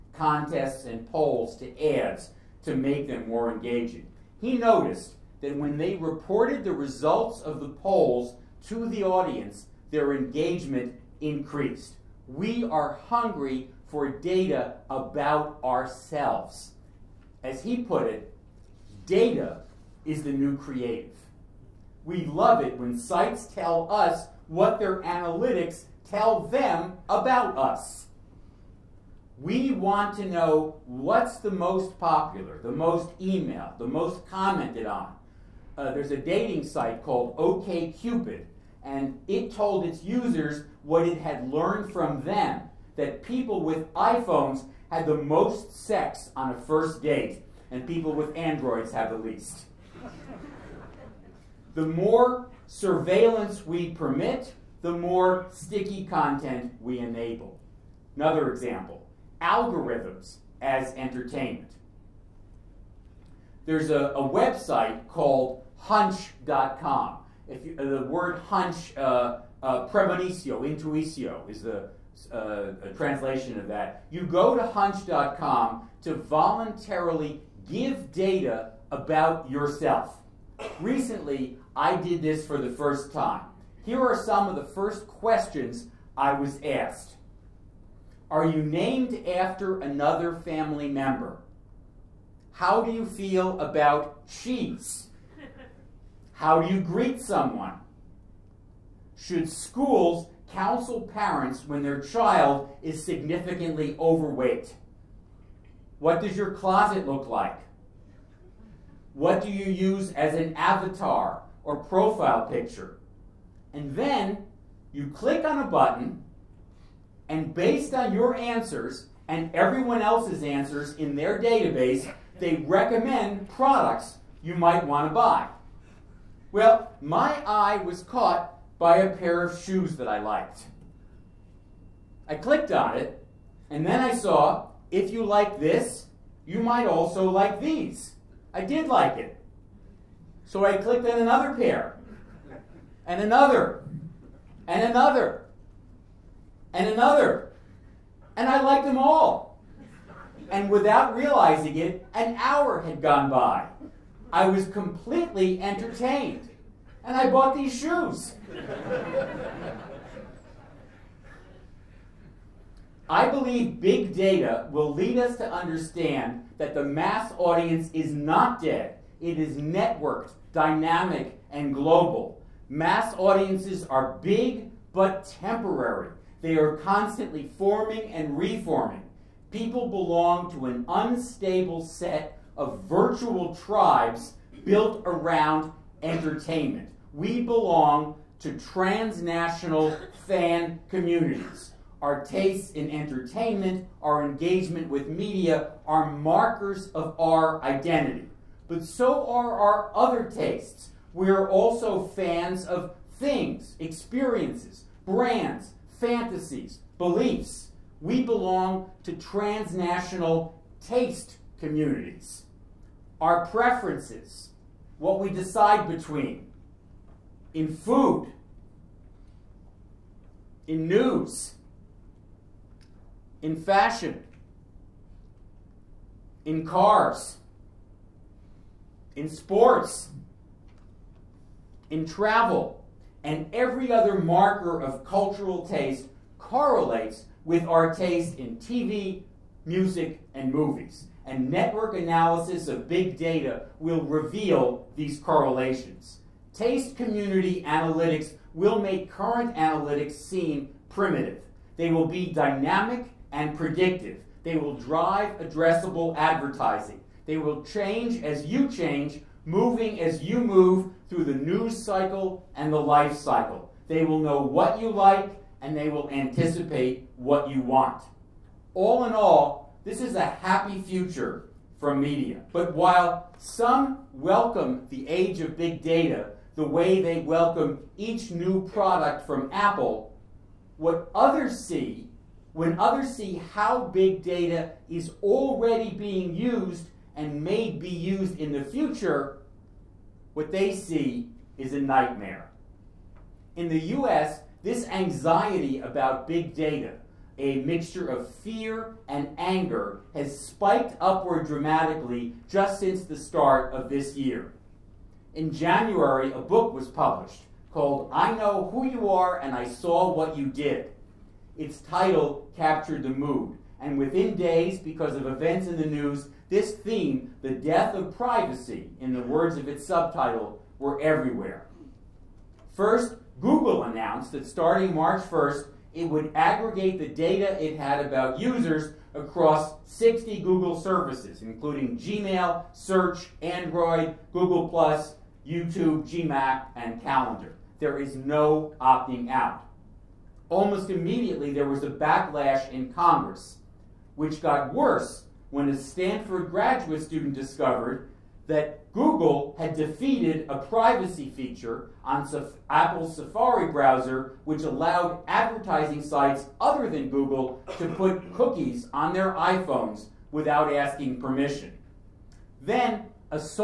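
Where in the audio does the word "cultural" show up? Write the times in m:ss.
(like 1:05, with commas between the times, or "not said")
3:55.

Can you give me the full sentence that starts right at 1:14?
You go to hunch.com to voluntarily give data about yourself.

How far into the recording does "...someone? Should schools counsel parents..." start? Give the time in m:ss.
1:37.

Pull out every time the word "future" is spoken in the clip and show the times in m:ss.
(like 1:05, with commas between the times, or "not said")
4:30, 4:48.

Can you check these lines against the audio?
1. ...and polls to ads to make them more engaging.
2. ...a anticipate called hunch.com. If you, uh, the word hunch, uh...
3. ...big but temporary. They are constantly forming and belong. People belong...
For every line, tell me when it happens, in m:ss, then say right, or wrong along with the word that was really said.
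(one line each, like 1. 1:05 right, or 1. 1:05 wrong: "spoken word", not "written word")
1. 0:00 right
2. 1:04 wrong: "website", not "anticipate"
3. 2:54 wrong: "reforming", not "belong".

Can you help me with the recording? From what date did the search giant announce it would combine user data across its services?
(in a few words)
March 1st.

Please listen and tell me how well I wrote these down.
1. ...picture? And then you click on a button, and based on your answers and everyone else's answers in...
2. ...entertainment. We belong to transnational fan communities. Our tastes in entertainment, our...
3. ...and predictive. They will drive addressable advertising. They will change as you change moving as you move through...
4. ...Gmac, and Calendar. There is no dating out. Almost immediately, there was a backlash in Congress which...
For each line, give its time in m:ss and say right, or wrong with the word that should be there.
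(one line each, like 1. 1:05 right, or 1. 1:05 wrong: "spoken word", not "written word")
1. 1:52 right
2. 3:06 right
3. 4:13 right
4. 5:36 wrong: "opting", not "dating".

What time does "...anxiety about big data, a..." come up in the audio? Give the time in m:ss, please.
4:54.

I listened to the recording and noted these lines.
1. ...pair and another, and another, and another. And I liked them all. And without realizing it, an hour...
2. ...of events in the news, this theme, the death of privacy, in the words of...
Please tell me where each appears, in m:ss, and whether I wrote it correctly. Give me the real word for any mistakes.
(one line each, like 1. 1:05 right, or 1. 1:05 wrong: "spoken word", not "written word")
1. 2:21 right
2. 5:15 right.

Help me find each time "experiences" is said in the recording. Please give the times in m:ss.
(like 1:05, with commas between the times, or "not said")
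3:23.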